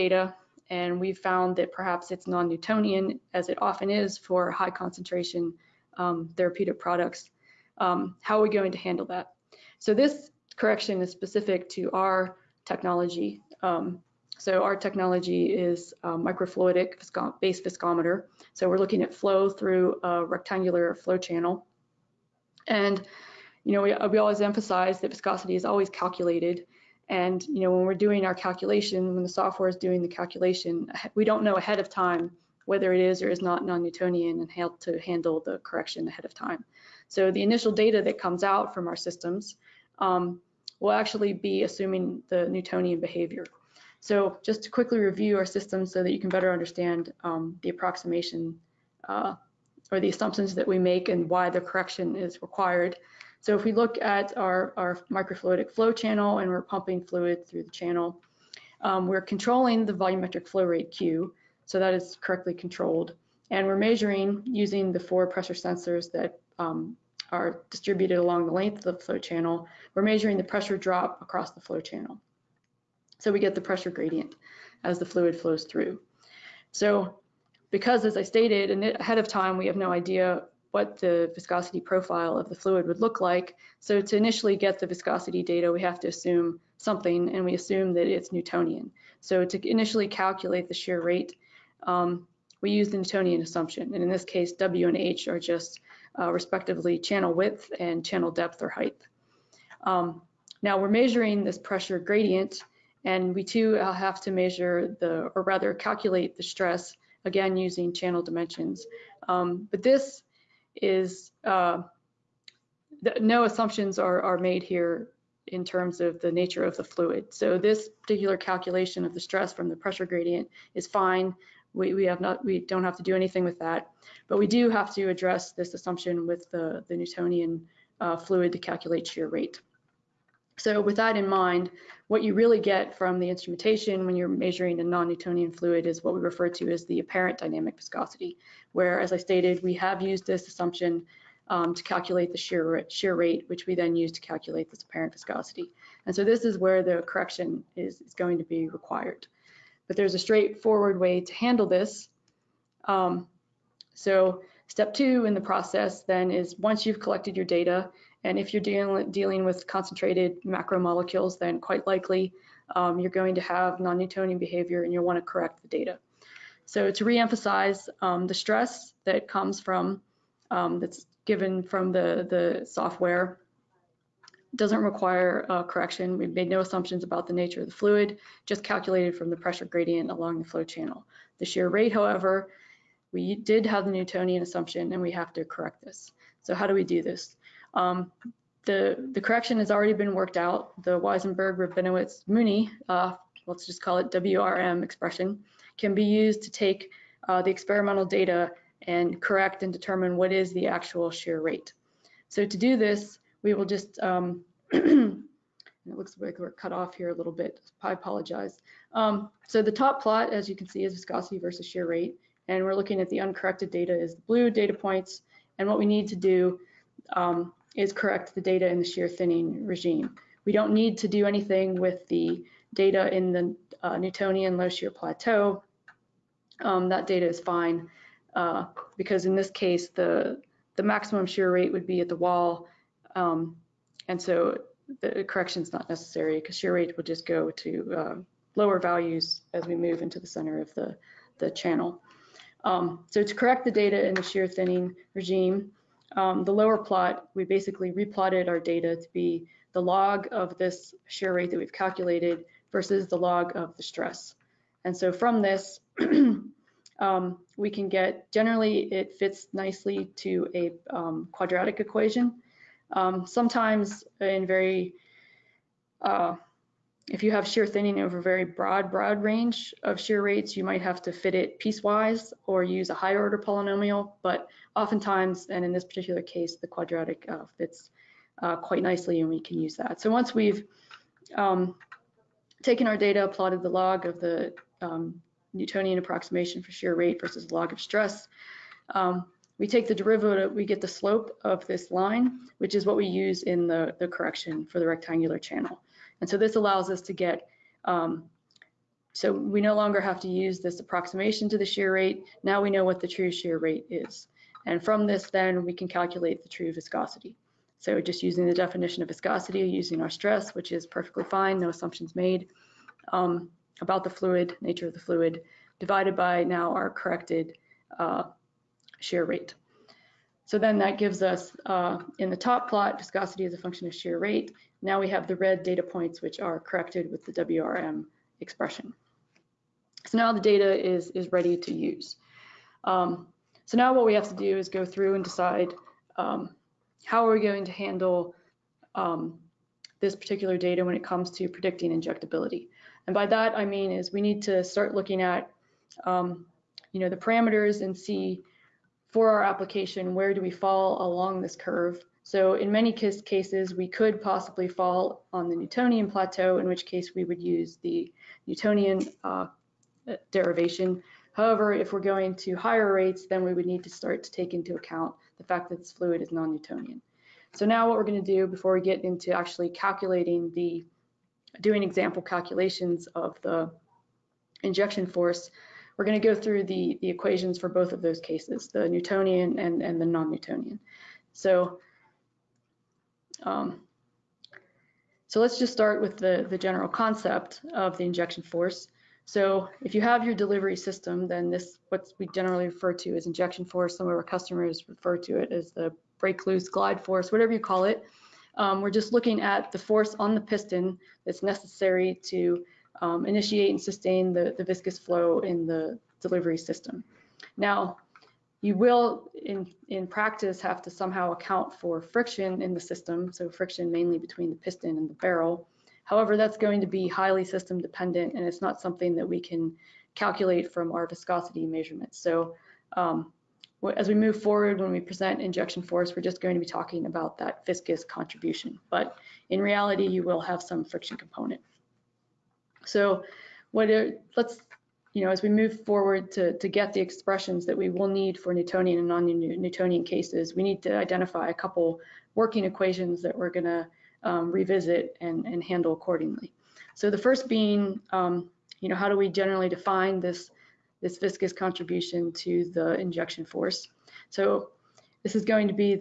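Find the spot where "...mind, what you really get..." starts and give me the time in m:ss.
2:11.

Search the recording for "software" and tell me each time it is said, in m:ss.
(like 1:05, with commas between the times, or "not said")
0:29, 2:52.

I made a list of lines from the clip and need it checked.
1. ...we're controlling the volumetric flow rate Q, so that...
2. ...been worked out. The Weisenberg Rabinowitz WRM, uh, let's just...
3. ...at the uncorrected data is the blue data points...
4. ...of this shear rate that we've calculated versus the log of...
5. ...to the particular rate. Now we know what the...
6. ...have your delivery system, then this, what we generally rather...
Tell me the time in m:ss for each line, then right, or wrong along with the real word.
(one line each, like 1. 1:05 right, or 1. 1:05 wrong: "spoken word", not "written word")
1. 0:59 right
2. 3:09 wrong: "Mooney", not "WRM"
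3. 3:33 right
4. 4:10 right
5. 5:01 wrong: "shear", not "particular"
6. 6:30 wrong: "refer", not "rather".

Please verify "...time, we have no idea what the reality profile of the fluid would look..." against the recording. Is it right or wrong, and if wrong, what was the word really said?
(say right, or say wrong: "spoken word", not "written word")
wrong: "viscosity", not "reality".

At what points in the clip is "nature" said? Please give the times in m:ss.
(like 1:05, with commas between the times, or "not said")
1:56, 2:57, 5:14.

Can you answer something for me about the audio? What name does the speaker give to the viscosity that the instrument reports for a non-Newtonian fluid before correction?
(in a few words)
apparent dynamic viscosity.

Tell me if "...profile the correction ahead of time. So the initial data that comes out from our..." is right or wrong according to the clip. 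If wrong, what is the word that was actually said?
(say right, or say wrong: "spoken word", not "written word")
wrong: "handle", not "profile".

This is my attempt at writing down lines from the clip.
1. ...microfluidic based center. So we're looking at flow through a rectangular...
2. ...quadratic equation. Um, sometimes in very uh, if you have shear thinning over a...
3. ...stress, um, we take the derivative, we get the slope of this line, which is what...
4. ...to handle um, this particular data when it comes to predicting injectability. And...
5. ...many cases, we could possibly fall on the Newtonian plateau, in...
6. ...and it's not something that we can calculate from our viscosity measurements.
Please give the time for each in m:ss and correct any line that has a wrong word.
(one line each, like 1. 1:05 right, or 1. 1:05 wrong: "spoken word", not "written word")
1. 0:16 wrong: "viscometer", not "center"
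2. 4:21 right
3. 4:47 right
4. 5:37 right
5. 5:52 right
6. 6:58 right.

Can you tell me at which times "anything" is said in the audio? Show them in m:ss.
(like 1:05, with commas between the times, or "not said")
2:03, 3:41.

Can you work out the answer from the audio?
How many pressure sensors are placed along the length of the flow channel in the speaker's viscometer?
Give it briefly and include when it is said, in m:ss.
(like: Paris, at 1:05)
4, at 1:05.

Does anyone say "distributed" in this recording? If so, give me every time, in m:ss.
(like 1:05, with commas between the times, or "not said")
1:07.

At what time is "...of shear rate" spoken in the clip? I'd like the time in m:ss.
5:23.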